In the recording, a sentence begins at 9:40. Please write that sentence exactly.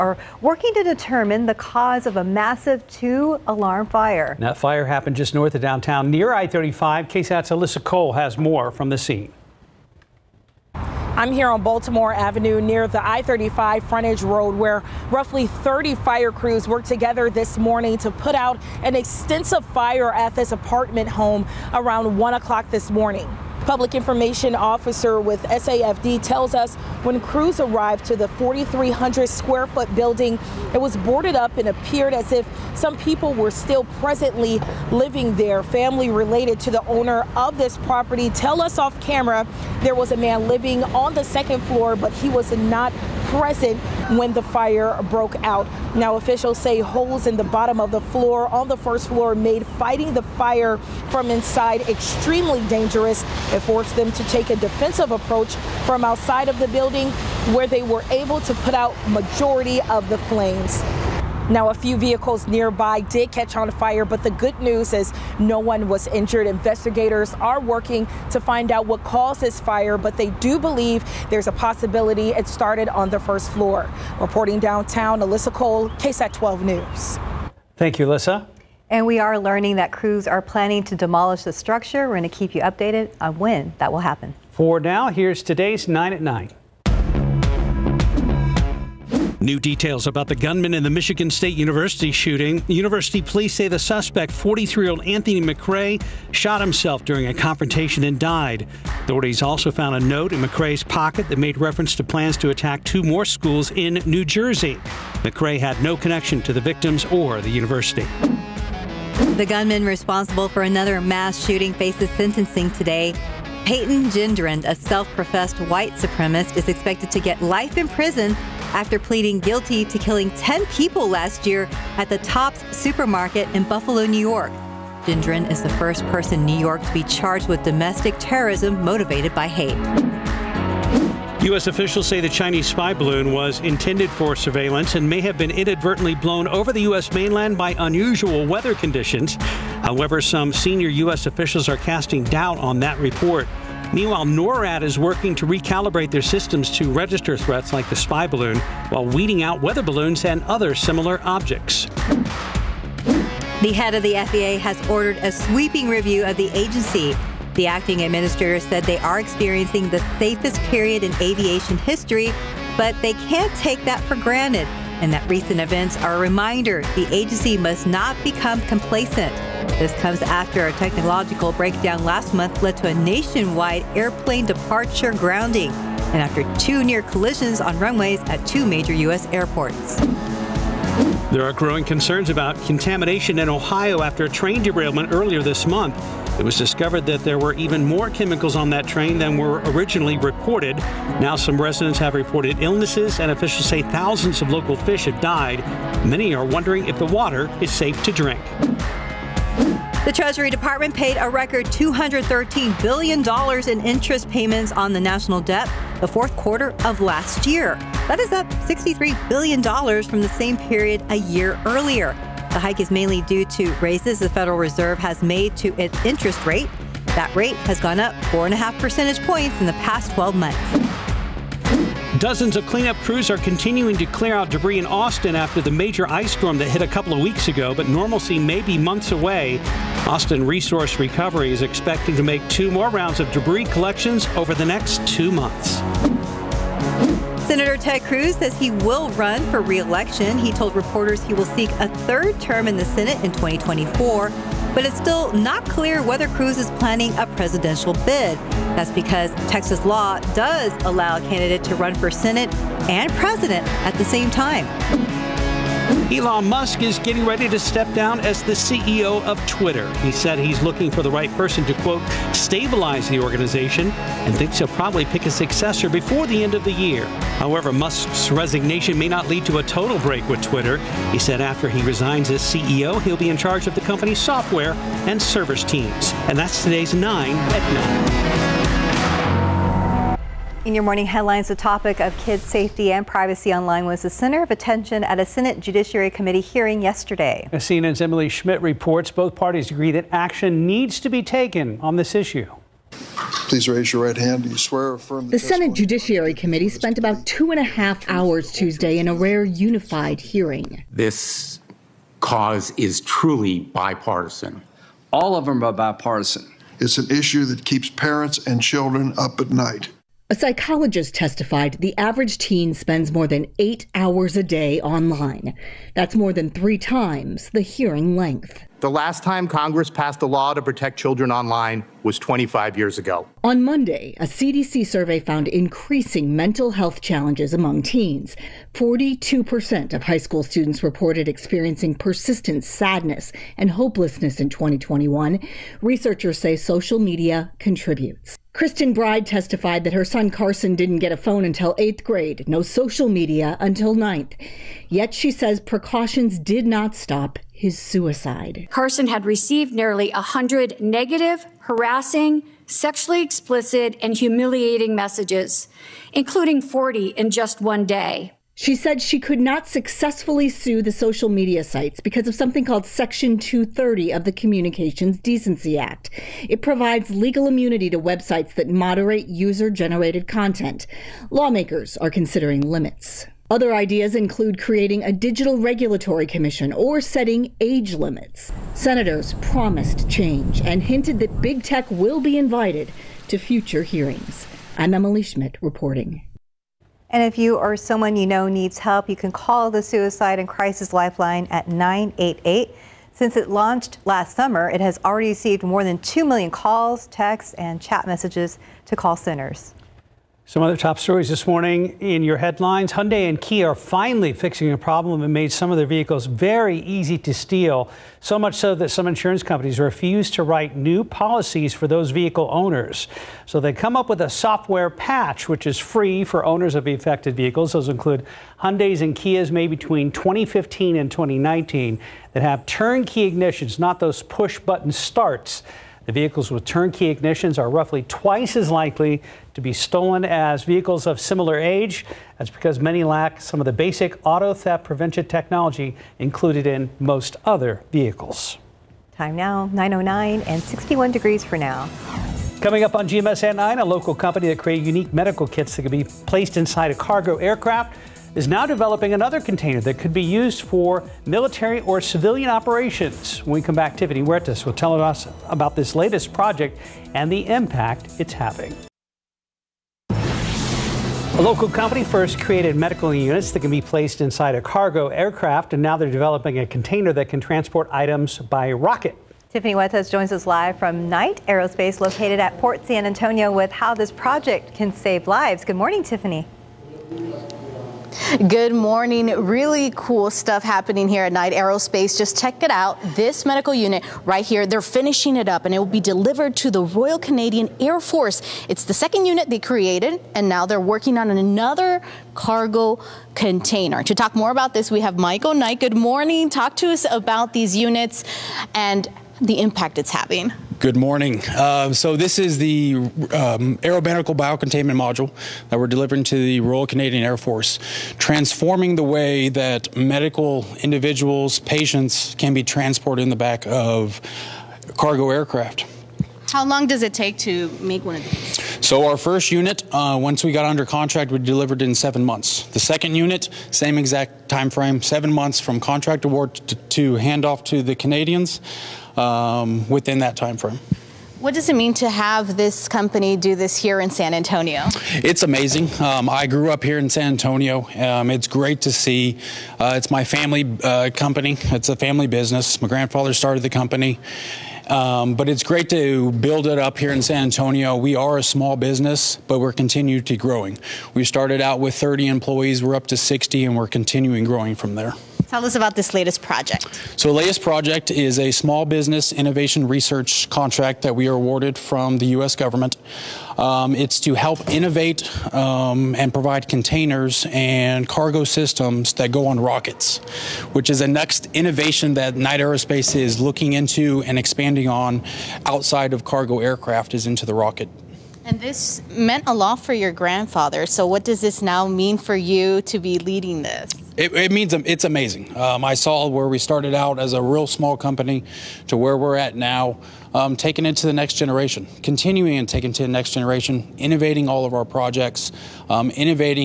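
So, what does this now mean for you to be leading this?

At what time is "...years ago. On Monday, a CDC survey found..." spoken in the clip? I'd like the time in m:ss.
5:22.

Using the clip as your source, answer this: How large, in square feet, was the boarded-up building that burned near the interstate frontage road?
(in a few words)
4,300.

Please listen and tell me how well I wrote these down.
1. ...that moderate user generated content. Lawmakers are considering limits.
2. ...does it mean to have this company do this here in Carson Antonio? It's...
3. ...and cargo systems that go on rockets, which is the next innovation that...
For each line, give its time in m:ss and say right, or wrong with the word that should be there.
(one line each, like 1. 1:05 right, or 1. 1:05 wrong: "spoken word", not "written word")
1. 6:08 right
2. 8:51 wrong: "San", not "Carson"
3. 9:27 right.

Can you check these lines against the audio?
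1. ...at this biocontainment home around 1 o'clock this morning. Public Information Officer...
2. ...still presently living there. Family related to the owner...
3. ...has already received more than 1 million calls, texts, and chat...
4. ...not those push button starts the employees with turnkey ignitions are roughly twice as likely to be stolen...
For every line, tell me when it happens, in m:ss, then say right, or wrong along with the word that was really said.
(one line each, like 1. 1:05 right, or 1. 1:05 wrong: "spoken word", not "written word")
1. 0:20 wrong: "apartment", not "biocontainment"
2. 0:33 right
3. 6:34 wrong: "2", not "1"
4. 7:03 wrong: "vehicles", not "employees".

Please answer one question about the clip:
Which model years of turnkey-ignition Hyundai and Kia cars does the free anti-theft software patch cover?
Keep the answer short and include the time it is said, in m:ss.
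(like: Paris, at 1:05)
2015 to 2019, at 7:00.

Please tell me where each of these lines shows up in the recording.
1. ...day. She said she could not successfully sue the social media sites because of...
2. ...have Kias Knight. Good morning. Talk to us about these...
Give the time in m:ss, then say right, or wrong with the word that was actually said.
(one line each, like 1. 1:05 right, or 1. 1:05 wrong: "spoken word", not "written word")
1. 5:57 right
2. 8:15 wrong: "Michael", not "Kias".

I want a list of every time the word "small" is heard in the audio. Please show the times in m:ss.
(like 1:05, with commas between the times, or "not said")
9:08, 9:18, 9:47.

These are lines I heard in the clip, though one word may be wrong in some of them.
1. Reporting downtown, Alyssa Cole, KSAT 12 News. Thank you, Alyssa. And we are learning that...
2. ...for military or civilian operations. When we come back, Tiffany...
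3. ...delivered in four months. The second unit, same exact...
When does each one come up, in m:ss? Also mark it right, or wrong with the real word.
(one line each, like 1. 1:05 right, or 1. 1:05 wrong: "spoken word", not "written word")
1. 1:14 right
2. 7:30 right
3. 8:41 wrong: "seven", not "four".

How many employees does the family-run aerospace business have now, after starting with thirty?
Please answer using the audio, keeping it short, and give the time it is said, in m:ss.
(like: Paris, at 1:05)
60, at 9:13.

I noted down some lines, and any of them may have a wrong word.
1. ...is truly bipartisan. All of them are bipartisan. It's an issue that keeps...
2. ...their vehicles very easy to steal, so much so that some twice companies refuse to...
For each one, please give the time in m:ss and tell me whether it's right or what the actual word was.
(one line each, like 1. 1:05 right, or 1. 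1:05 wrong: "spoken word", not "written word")
1. 5:02 right
2. 6:45 wrong: "insurance", not "twice".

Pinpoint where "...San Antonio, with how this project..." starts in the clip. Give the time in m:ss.
7:52.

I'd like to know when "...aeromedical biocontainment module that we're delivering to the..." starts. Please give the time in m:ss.
8:23.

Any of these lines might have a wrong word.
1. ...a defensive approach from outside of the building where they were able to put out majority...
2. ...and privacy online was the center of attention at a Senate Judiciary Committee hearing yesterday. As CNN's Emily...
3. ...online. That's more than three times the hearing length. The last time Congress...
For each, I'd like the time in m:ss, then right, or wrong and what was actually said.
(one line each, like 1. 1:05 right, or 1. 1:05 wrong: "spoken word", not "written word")
1. 0:54 right
2. 4:42 right
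3. 5:14 right.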